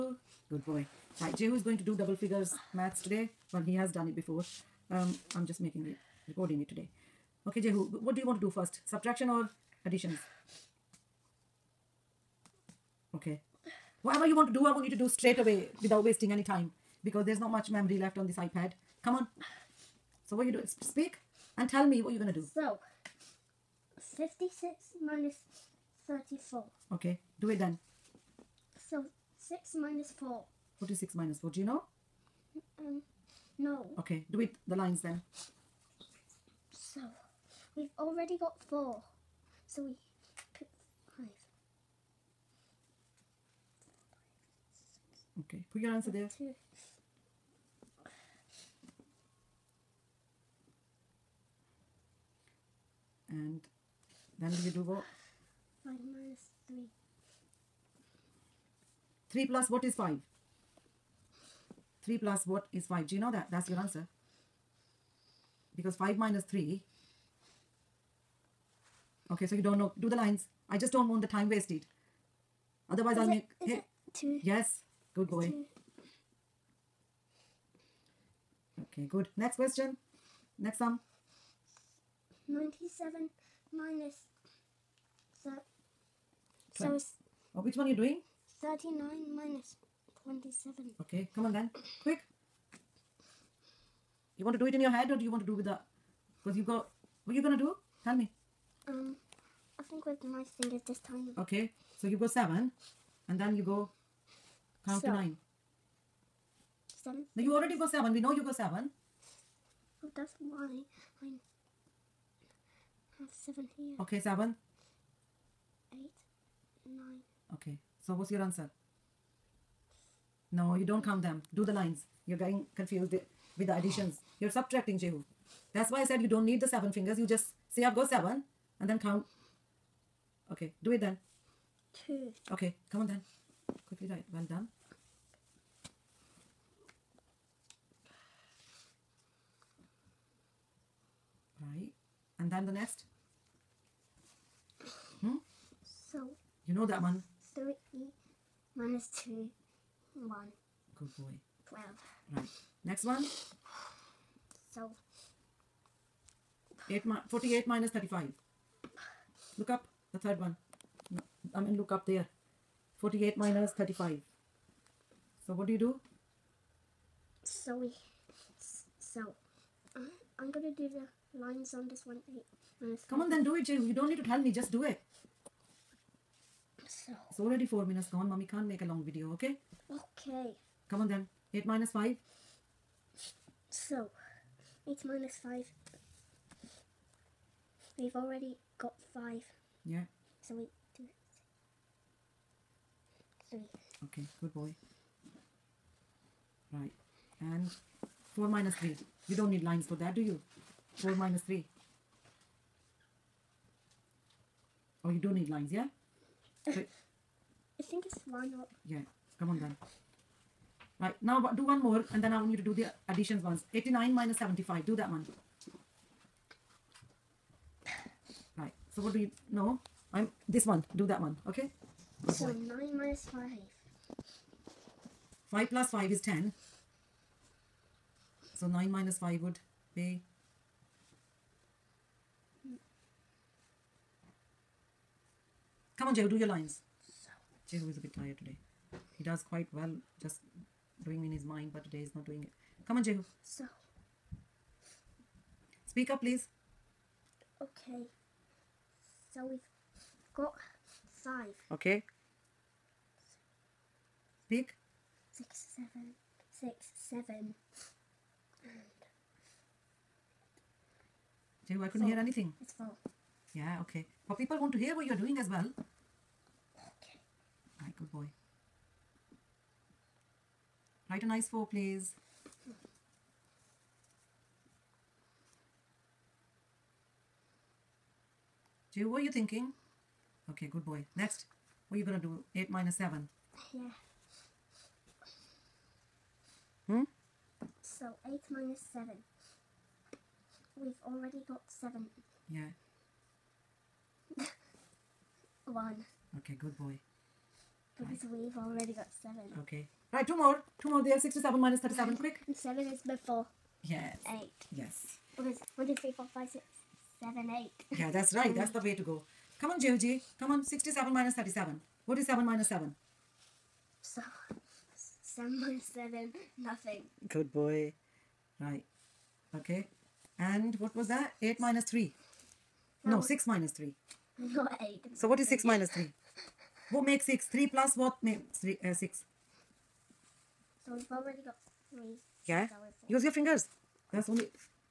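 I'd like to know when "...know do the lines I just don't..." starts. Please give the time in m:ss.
1:09.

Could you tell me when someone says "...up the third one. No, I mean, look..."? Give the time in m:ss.
2:39.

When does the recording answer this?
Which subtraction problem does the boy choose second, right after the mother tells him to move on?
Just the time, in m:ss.
1:28.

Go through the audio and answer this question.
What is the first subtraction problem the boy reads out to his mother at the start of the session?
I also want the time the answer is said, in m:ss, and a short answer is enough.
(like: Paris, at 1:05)
56 minus 34, at 0:24.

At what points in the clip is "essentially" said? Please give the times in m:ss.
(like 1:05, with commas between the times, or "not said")
not said.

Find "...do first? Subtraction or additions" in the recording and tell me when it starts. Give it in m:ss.
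0:08.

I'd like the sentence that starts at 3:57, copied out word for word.
Jehu is a bit tired today.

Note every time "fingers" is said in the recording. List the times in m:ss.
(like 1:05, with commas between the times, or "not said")
1:40, 2:06, 5:33.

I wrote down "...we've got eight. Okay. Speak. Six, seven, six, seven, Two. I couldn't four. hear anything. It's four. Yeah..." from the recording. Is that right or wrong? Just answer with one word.
wrong.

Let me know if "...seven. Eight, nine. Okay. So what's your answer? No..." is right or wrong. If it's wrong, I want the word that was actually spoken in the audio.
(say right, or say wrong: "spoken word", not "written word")
right.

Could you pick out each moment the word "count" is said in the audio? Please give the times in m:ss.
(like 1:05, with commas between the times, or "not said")
1:44, 2:01, 2:08.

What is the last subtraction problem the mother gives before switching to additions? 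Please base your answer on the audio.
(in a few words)
89 minus 75.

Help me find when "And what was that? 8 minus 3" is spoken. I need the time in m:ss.
5:20.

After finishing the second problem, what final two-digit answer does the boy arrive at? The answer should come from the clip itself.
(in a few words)
12.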